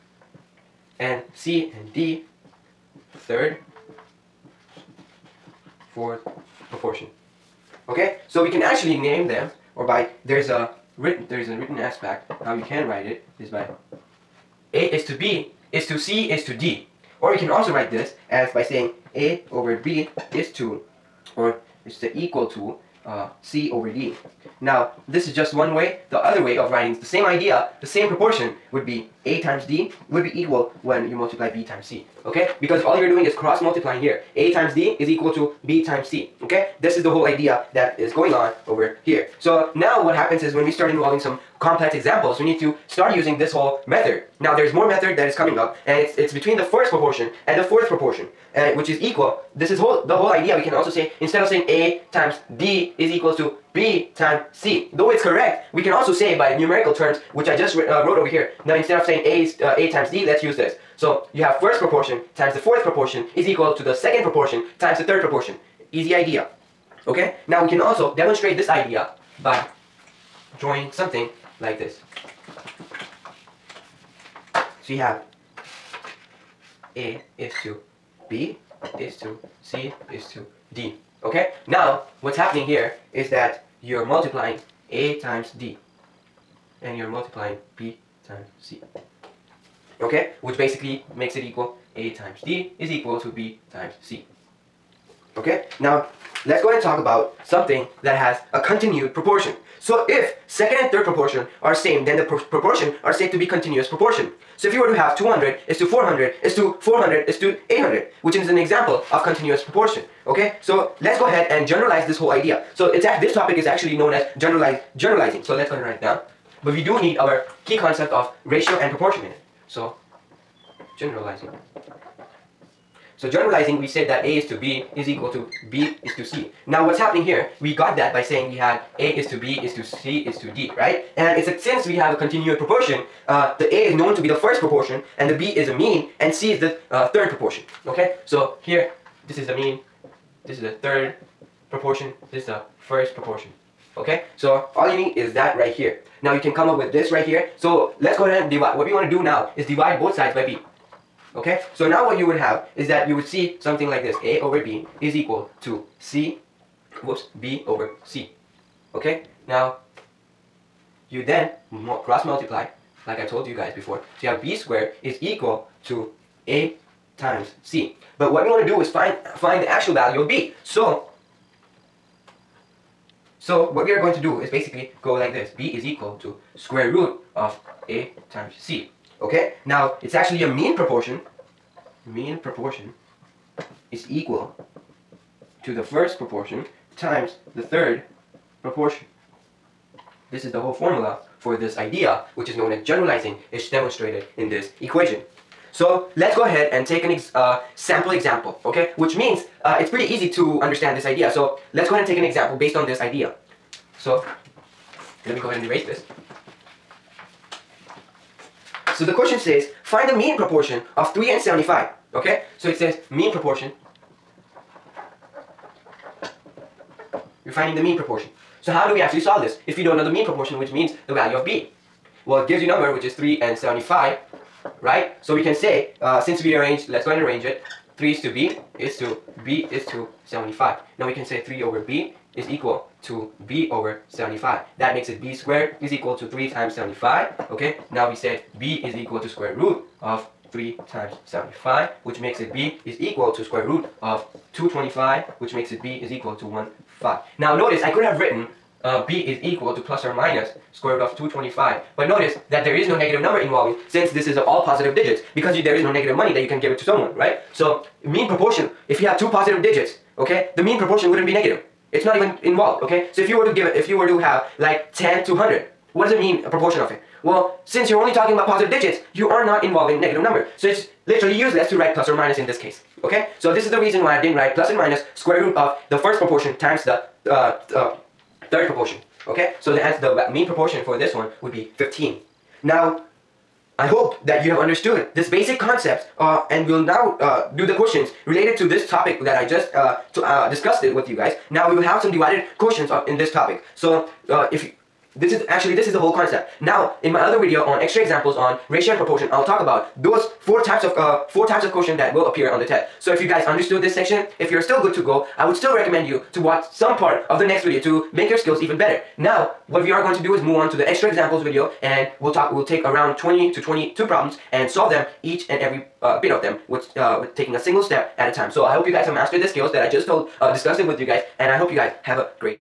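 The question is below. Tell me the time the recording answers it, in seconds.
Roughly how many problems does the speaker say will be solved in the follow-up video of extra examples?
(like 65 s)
313 s.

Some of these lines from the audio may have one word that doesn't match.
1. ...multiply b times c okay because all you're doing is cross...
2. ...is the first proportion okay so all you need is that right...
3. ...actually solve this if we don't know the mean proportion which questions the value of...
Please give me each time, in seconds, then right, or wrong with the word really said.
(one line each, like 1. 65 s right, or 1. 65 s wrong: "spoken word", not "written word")
1. 31 s right
2. 142 s right
3. 219 s wrong: "means", not "questions".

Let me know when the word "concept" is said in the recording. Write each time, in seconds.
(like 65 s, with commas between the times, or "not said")
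117 s, 285 s, 296 s.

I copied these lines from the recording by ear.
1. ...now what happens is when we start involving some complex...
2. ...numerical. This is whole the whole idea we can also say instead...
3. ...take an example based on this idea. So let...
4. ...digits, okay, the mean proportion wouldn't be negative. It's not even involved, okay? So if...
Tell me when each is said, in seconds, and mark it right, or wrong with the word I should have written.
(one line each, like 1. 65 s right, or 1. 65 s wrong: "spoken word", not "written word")
1. 39 s right
2. 48 s wrong: "equal", not "numerical"
3. 202 s right
4. 259 s right.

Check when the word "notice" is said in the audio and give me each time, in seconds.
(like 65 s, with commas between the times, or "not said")
247 s, 252 s.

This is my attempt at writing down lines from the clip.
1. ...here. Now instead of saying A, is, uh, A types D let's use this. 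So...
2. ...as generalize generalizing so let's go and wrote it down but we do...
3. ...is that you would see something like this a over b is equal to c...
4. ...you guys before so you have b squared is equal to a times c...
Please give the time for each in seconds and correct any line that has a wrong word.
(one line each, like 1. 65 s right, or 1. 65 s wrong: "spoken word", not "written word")
1. 58 s wrong: "times", not "types"
2. 114 s wrong: "write", not "wrote"
3. 152 s right
4. 163 s right.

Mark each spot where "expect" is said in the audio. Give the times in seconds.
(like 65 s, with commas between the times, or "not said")
not said.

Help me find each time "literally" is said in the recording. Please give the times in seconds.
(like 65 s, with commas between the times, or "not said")
271 s.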